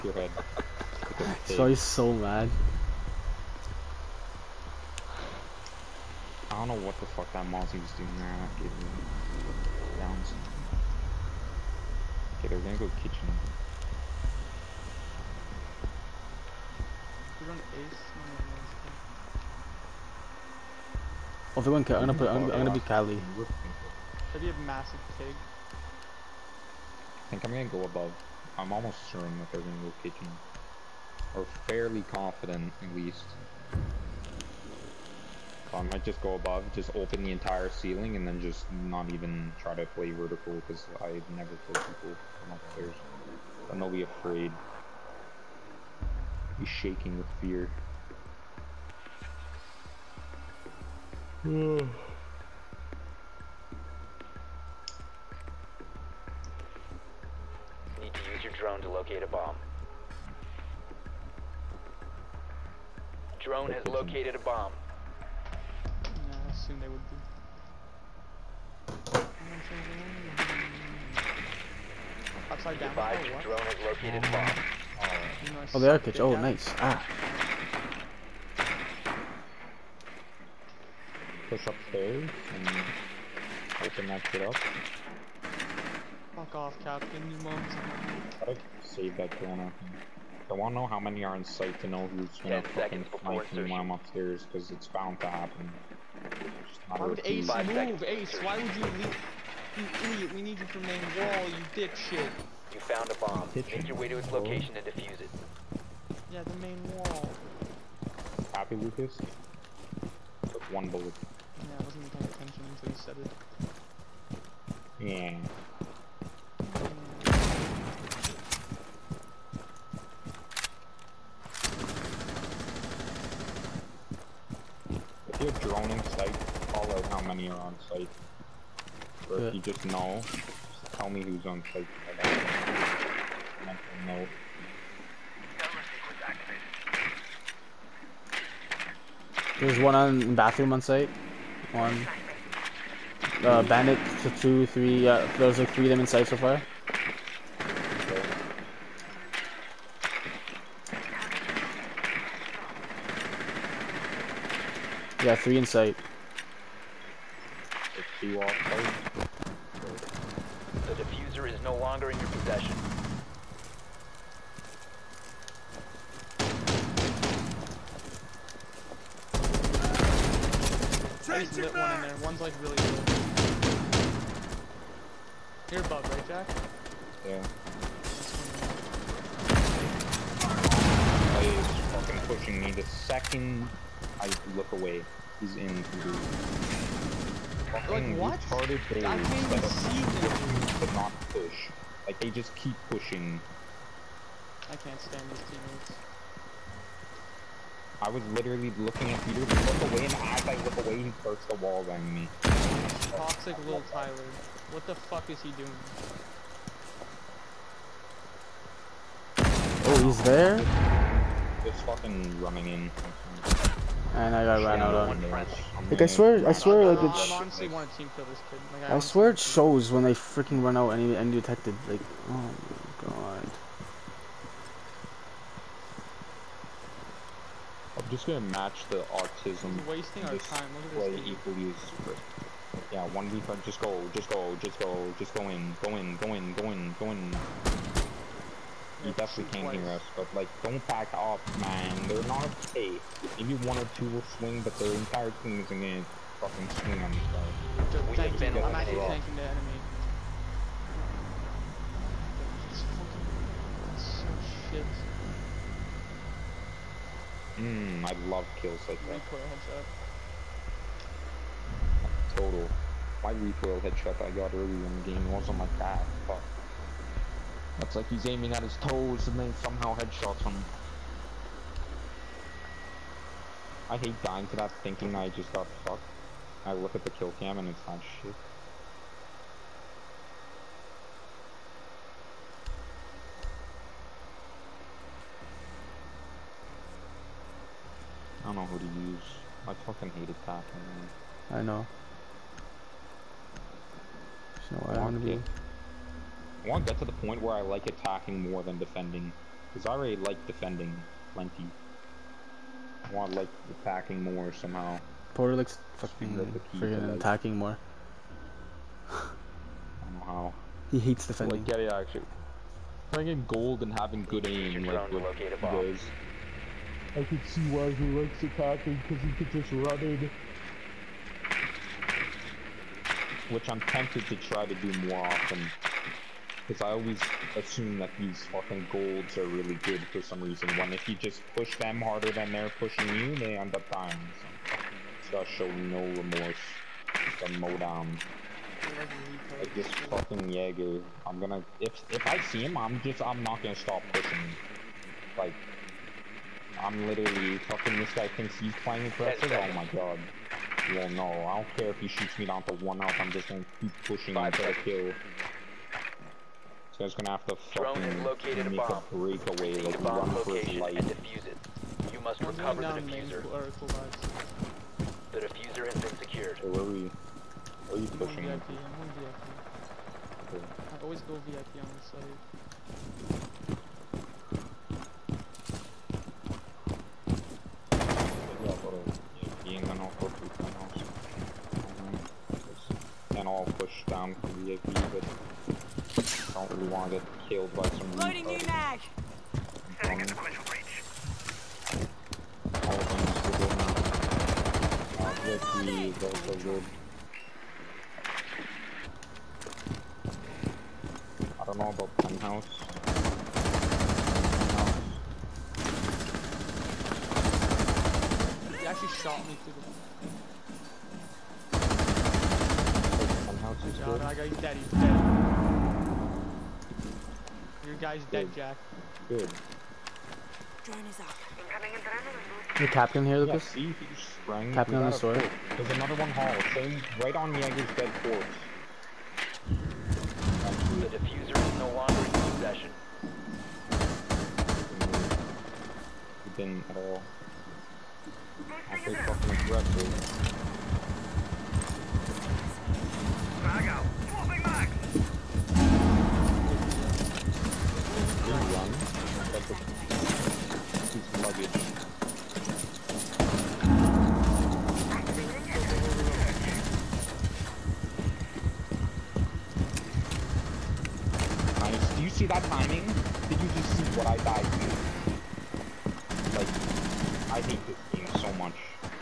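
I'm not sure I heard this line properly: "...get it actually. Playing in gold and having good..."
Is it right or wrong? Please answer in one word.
right.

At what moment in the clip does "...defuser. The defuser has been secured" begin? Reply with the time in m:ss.
6:02.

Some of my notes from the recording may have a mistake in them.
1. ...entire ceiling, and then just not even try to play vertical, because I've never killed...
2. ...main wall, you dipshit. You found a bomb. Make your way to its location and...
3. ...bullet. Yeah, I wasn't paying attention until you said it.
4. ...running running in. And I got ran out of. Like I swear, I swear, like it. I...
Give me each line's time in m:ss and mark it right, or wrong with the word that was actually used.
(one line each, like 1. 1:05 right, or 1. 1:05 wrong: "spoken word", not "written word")
1. 0:37 right
2. 1:40 right
3. 1:50 right
4. 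3:31 wrong: "fucking", not "running".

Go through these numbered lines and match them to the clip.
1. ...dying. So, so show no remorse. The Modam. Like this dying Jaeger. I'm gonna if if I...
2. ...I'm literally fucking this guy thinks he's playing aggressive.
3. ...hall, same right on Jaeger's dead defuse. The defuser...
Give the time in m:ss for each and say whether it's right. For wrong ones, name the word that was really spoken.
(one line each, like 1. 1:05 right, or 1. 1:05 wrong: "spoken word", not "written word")
1. 5:33 wrong: "fucking", not "dying"
2. 5:46 right
3. 7:06 wrong: "corpse", not "defuse".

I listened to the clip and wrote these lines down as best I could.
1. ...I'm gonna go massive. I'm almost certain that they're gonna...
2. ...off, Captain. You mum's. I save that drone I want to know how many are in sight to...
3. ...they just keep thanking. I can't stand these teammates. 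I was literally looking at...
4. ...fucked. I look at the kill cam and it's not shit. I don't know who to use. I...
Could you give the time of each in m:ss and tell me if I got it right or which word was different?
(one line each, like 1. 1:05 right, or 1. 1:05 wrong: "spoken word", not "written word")
1. 0:27 wrong: "above", not "massive"
2. 1:26 right
3. 3:12 wrong: "pushing", not "thanking"
4. 4:35 right.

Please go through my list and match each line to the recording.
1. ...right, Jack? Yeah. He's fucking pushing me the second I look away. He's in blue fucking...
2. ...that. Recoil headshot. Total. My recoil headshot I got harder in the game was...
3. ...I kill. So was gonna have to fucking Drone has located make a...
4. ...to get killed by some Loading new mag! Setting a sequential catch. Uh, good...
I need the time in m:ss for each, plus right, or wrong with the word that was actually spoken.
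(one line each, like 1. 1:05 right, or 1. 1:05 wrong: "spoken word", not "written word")
1. 2:56 right
2. 4:19 wrong: "earlier", not "harder"
3. 5:54 right
4. 6:27 wrong: "breach", not "catch".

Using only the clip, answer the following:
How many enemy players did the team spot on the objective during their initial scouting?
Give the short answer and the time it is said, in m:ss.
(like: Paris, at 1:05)
3, at 2:25.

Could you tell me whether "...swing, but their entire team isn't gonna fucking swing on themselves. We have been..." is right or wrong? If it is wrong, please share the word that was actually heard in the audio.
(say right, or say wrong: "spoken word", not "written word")
right.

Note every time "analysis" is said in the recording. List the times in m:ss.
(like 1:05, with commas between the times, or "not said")
not said.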